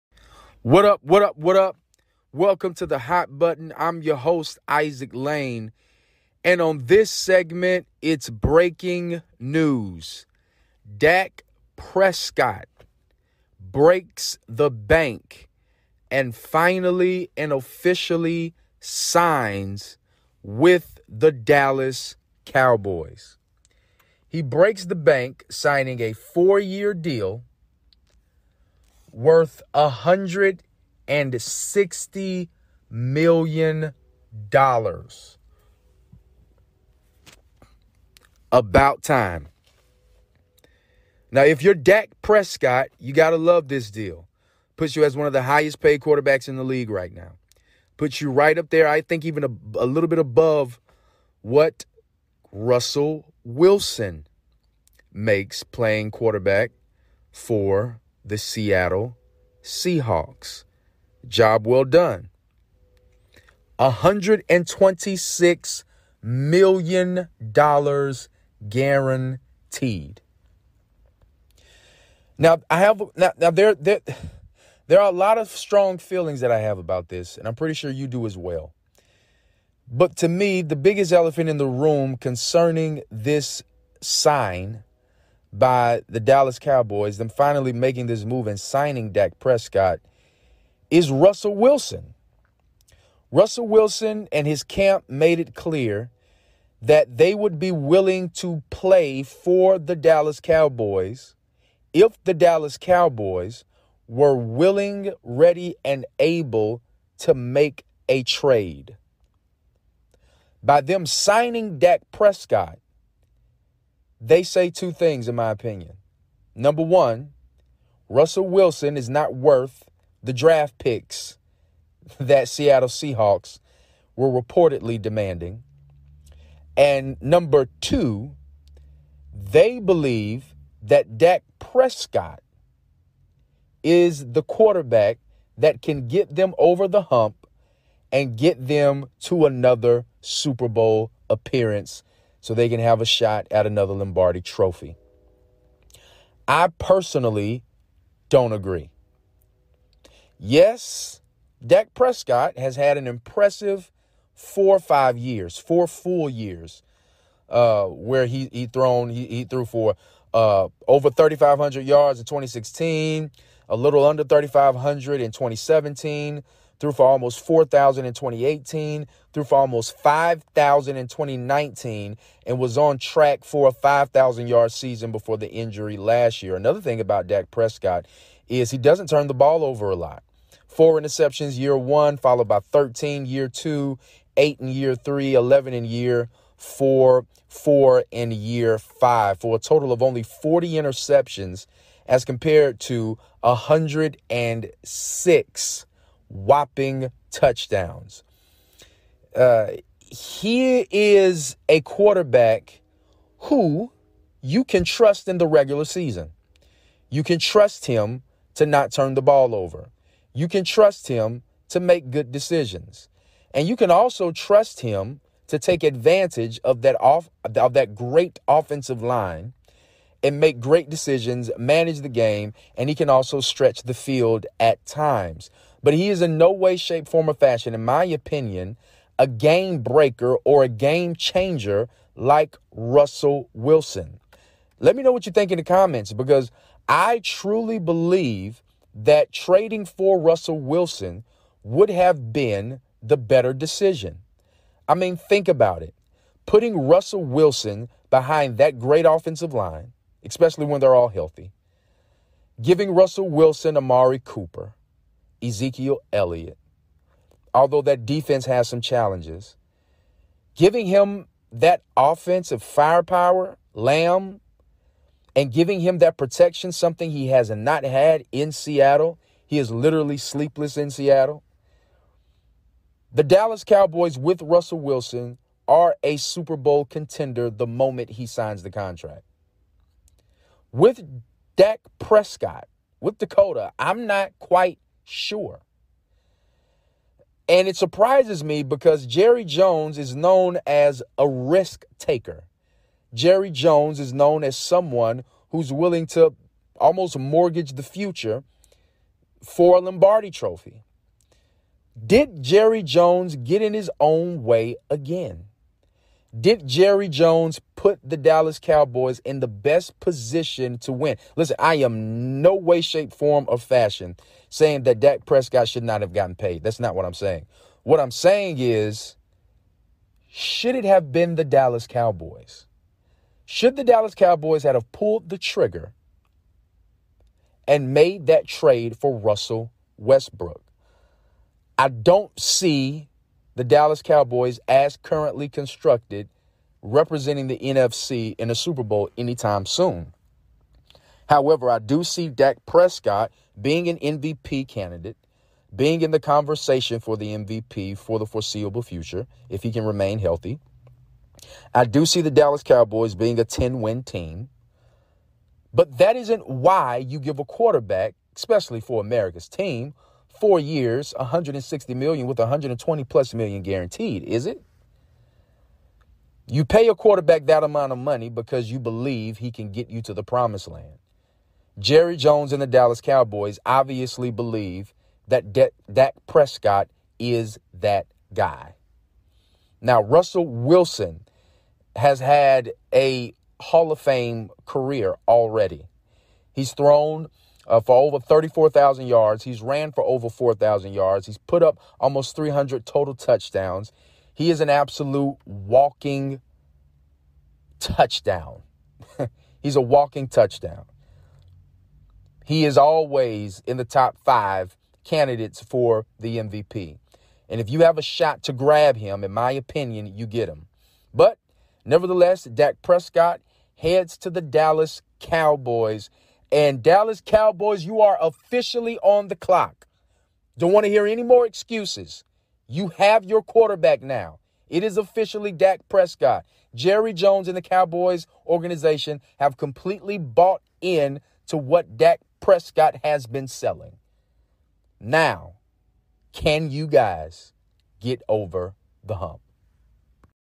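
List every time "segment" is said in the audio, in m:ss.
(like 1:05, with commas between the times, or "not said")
0:07.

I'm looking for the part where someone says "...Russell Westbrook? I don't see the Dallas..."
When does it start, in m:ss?
5:29.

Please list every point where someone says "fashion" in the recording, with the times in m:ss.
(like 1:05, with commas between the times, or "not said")
3:47, 5:13.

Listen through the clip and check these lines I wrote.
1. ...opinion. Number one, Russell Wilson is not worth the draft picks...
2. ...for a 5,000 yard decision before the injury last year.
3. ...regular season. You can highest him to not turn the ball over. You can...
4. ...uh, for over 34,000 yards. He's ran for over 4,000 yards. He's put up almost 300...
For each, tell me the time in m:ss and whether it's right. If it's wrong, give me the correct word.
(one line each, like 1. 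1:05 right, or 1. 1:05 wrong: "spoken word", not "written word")
1. 1:55 right
2. 2:53 wrong: "season", not "decision"
3. 3:25 wrong: "trust", not "highest"
4. 6:27 right.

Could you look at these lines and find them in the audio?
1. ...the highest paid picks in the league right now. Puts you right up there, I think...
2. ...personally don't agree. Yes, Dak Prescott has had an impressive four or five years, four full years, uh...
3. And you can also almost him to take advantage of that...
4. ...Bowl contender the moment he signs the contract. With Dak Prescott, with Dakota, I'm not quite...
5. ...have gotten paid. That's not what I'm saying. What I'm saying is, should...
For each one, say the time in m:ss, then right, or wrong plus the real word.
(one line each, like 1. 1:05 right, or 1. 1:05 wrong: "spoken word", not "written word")
1. 0:45 wrong: "quarterbacks", not "picks"
2. 2:26 right
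3. 3:33 wrong: "trust", not "almost"
4. 4:36 right
5. 5:15 right.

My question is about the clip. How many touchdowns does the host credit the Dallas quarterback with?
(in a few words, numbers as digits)
106.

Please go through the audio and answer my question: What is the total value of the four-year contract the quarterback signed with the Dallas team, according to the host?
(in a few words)
$160 million.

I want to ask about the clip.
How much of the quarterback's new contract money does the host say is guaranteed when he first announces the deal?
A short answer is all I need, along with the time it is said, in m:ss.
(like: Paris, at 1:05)
$126 million, at 1:03.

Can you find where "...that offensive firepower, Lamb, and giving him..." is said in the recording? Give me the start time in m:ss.
4:21.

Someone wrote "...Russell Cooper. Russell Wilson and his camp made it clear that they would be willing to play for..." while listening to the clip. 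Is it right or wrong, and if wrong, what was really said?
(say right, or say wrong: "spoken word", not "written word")
wrong: "Wilson", not "Cooper".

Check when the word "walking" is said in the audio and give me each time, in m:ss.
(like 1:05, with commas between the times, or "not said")
6:35, 6:39.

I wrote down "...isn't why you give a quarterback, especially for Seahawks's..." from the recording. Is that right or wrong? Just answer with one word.
wrong.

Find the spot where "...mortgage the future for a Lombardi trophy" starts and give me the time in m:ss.
4:57.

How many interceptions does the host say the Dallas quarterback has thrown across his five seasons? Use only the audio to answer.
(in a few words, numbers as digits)
40.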